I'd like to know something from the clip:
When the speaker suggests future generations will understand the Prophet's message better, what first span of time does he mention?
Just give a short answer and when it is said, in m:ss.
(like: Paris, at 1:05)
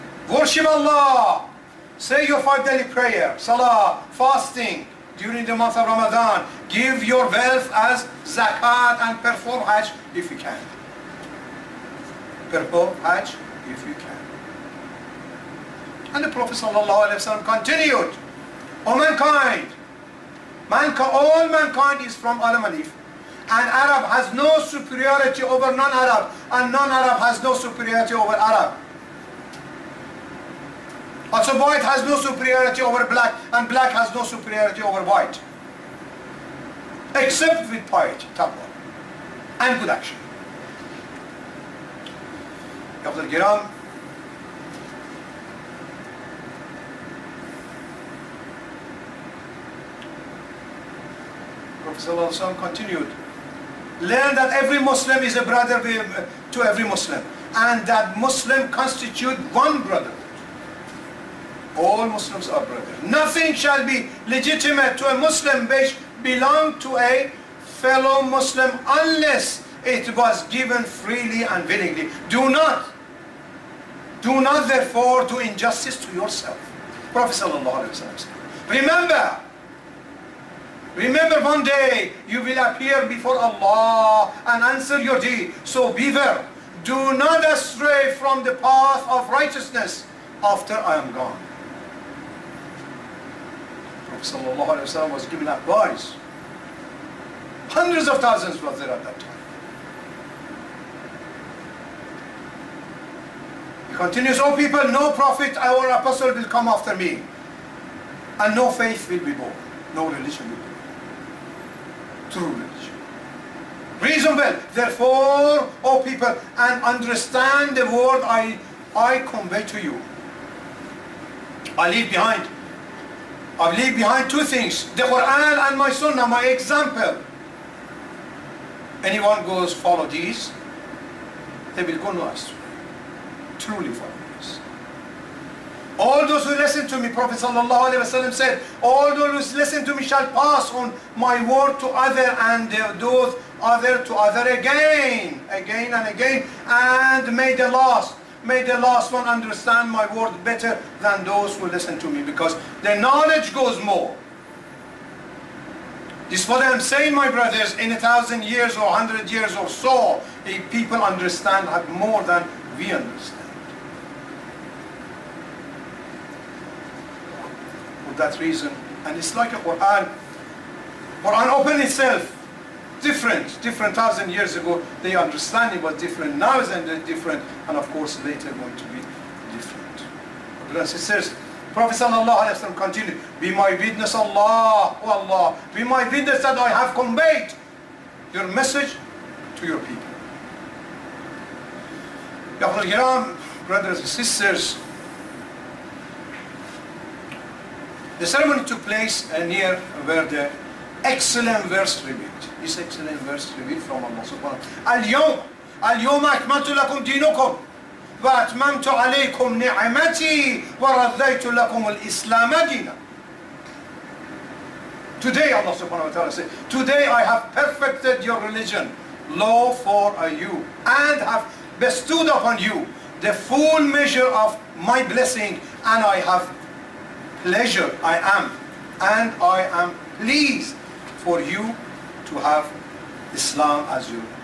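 a thousand years, at 2:37.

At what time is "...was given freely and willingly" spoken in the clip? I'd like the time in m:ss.
1:10.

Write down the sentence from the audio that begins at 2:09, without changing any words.
Anyone goes follow these, they will go no astray.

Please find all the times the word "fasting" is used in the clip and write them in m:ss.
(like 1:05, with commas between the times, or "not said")
0:04.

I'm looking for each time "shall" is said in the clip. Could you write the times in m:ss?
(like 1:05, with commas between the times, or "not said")
1:03, 2:20.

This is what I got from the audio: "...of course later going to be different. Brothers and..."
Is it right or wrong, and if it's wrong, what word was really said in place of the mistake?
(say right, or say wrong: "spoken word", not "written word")
right.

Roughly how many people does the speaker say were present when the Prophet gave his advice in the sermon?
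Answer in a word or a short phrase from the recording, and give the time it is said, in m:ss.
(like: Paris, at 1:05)
Hundreds of thousands, at 1:37.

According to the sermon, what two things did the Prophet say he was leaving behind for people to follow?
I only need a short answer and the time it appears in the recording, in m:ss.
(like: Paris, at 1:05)
the Quran and my Sunnah, at 2:04.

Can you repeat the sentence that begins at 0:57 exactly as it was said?
And that Muslim constitute one brother.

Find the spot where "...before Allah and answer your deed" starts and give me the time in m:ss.
1:23.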